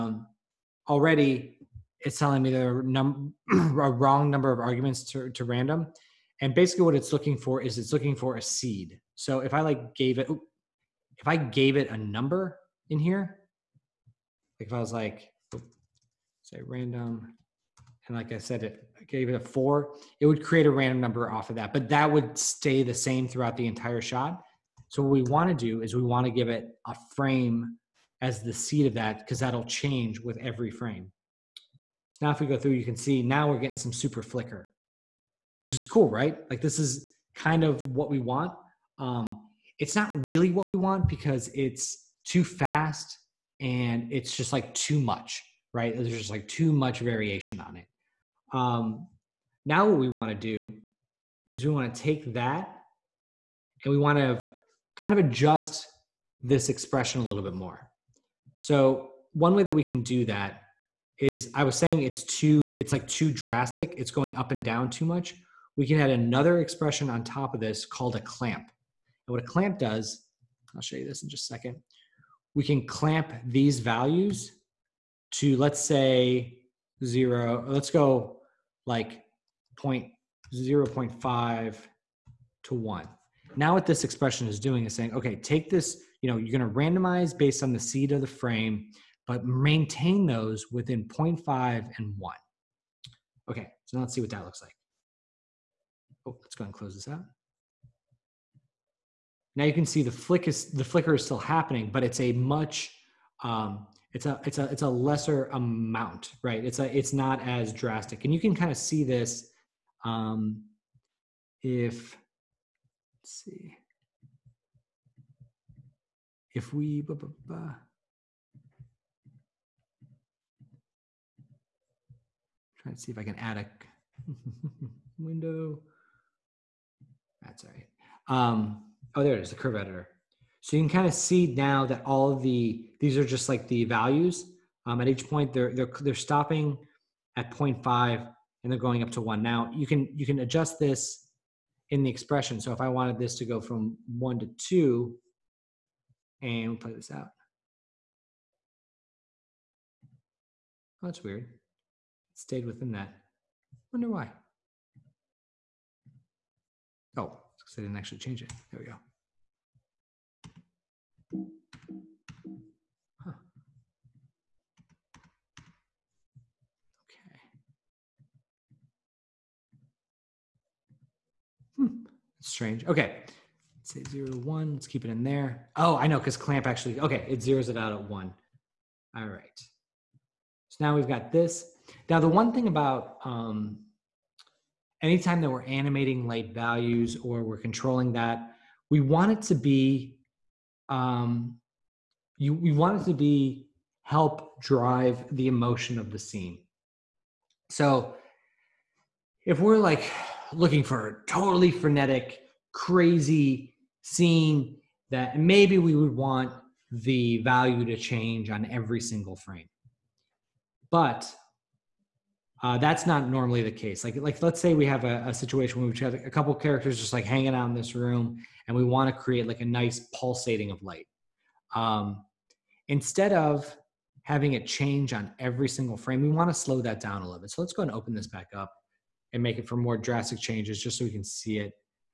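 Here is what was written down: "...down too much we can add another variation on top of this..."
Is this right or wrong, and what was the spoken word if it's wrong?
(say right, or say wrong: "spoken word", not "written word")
wrong: "expression", not "variation".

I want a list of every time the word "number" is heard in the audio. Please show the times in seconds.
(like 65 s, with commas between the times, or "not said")
4 s, 11 s, 21 s.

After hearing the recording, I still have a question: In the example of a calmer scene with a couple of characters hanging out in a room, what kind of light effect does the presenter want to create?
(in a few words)
pulsating of light.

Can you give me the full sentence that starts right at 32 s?
So now if we go through, you can see now we're getting some super flicker which is cool, right?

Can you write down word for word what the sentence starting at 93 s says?
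Okay, so now let's see what that looks like oh, let's go and close this out.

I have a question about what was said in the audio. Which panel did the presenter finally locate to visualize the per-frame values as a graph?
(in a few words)
curve editor.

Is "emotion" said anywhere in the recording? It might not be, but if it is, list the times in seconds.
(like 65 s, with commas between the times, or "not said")
195 s.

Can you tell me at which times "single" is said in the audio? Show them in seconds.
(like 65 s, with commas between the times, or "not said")
209 s, 225 s.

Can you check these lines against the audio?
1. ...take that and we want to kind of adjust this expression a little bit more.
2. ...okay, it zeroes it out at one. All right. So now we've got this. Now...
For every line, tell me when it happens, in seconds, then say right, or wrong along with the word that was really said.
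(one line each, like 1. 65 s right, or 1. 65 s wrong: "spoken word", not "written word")
1. 51 s right
2. 176 s right.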